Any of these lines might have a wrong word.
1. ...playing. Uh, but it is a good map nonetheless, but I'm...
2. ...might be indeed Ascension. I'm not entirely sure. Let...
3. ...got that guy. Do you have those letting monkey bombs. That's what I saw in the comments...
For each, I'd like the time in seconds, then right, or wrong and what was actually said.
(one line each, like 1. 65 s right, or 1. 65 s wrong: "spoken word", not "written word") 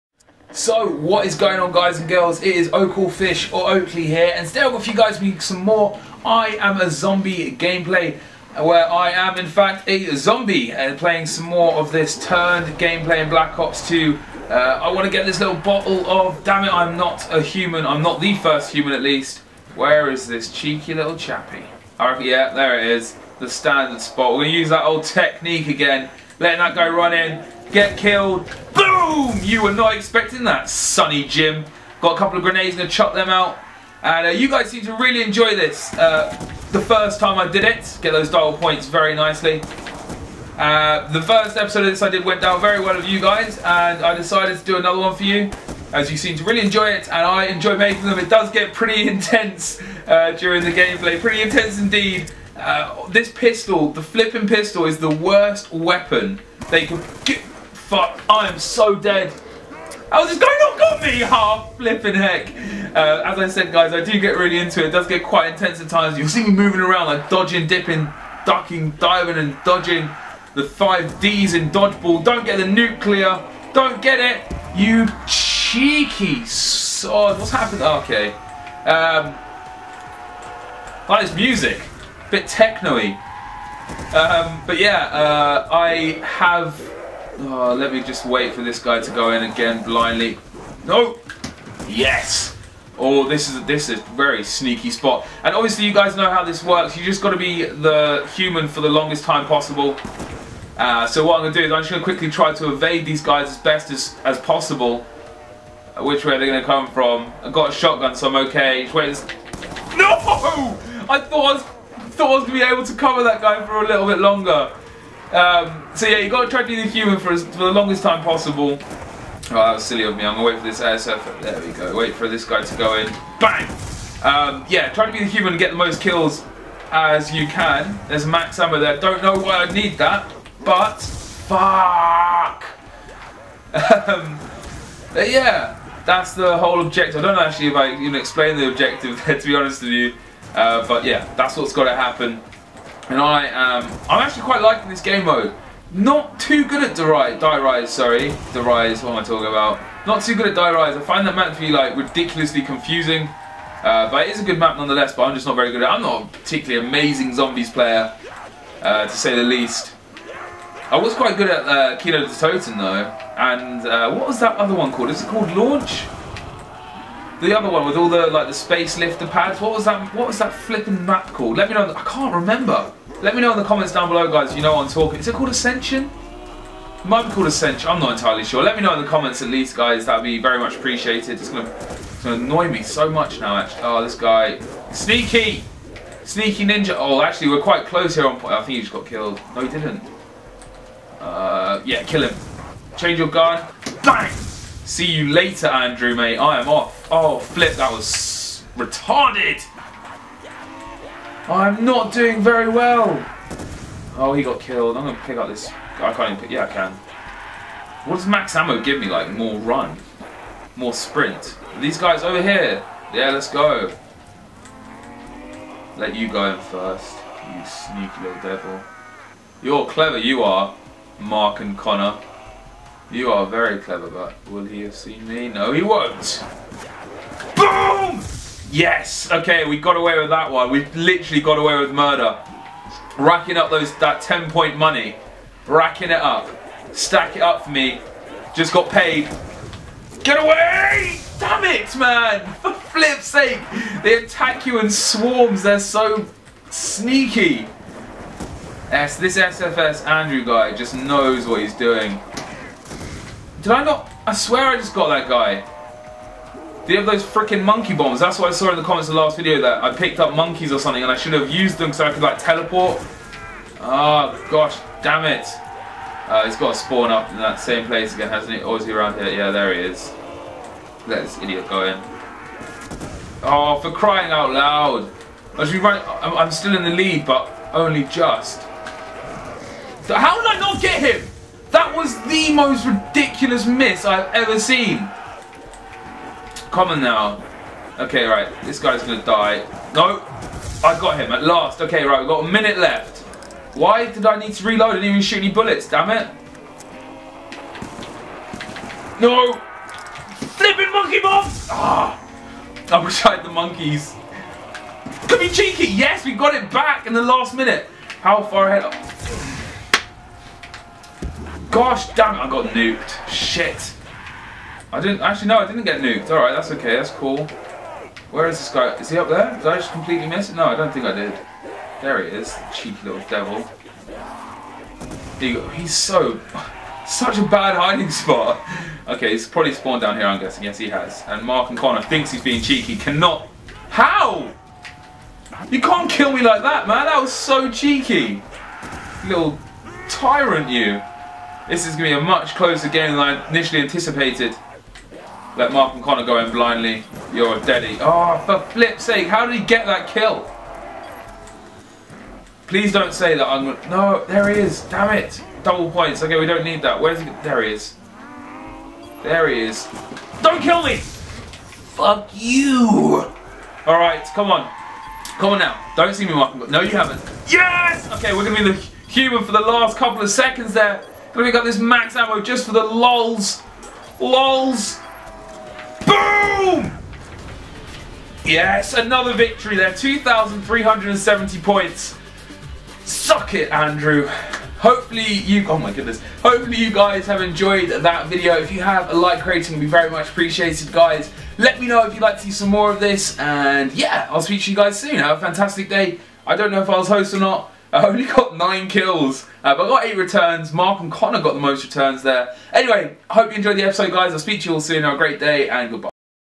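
1. 152 s wrong: "confusing", not "playing"
2. 177 s wrong: "called", not "indeed"
3. 254 s wrong: "freaking", not "letting".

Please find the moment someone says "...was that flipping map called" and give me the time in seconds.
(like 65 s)
170 s.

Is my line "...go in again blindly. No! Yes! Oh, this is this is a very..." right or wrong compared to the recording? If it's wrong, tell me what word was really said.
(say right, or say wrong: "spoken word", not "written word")
right.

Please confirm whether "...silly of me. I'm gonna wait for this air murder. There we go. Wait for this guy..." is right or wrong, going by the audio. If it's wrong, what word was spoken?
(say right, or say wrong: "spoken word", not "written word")
wrong: "surfer", not "murder".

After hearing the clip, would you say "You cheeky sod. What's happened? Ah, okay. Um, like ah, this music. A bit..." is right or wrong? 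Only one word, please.
right.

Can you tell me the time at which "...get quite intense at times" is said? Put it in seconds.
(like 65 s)
65 s.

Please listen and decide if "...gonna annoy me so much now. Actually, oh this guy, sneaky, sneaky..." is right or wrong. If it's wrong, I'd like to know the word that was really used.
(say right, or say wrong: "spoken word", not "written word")
right.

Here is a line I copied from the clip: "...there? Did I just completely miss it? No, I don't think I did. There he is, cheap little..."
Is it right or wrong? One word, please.
right.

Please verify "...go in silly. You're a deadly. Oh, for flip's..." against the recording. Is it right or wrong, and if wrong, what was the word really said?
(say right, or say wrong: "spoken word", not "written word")
wrong: "blindly", not "silly".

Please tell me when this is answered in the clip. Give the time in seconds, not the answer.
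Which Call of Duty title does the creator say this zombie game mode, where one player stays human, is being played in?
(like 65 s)
13 s.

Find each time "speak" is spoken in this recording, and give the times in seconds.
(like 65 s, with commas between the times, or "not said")
394 s, 404 s.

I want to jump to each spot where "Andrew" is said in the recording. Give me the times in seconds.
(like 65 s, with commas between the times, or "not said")
195 s, 250 s, 383 s.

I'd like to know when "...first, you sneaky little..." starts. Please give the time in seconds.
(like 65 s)
216 s.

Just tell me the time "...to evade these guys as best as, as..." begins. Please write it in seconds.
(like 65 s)
102 s.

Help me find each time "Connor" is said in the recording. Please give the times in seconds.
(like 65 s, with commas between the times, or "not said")
221 s, 331 s, 346 s, 401 s.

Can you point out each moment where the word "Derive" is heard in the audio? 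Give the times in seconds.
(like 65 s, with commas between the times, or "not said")
146 s.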